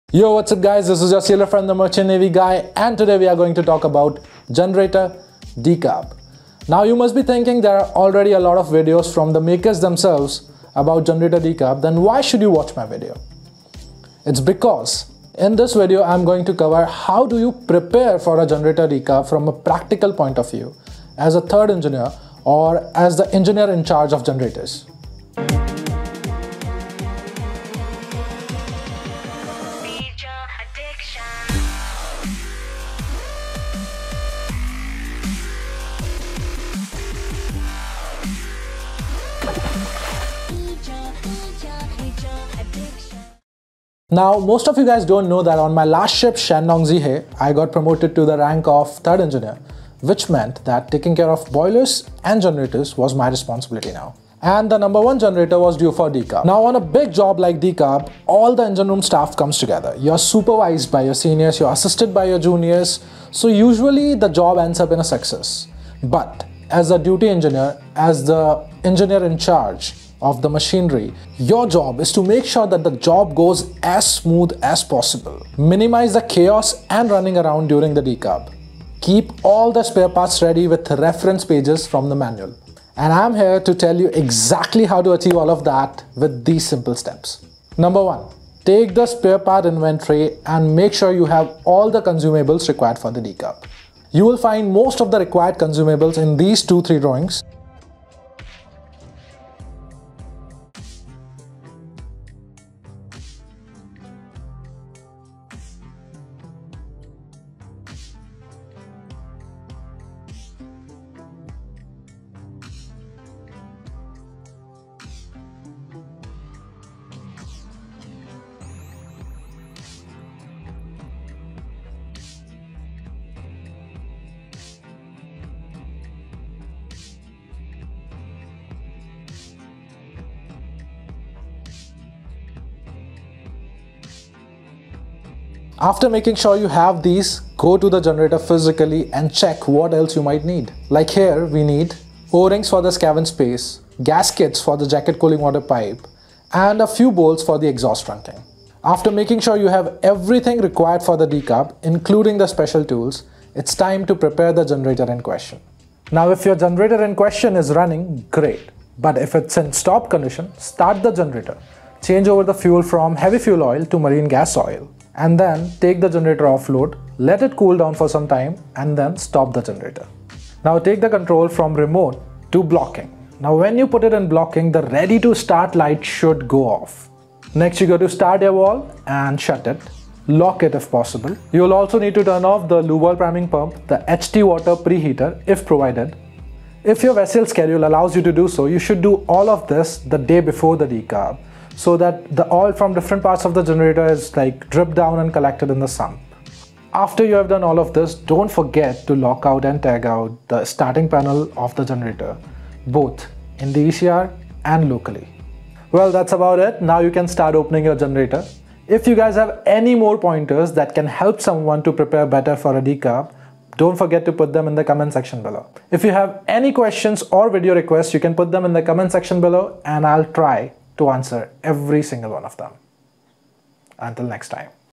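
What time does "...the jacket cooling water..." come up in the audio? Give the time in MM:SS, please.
02:24.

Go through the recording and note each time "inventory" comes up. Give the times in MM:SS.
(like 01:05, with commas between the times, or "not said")
01:29.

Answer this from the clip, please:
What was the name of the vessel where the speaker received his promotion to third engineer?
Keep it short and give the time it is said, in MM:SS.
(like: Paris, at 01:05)
Shandong Zihe, at 00:46.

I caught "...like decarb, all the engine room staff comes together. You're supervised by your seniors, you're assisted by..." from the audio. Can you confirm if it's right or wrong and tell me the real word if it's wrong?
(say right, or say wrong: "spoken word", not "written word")
right.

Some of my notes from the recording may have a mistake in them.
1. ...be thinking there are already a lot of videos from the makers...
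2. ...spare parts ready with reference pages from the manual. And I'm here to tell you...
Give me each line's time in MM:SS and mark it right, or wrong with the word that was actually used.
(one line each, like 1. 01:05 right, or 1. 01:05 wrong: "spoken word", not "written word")
1. 00:07 right
2. 01:19 right.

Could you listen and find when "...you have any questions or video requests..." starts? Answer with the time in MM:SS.
03:36.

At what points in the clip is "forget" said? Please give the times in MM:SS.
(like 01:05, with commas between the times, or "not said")
03:18, 03:33.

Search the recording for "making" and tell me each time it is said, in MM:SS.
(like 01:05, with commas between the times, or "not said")
02:16, 02:29.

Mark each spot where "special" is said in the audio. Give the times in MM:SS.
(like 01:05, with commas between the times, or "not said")
02:32.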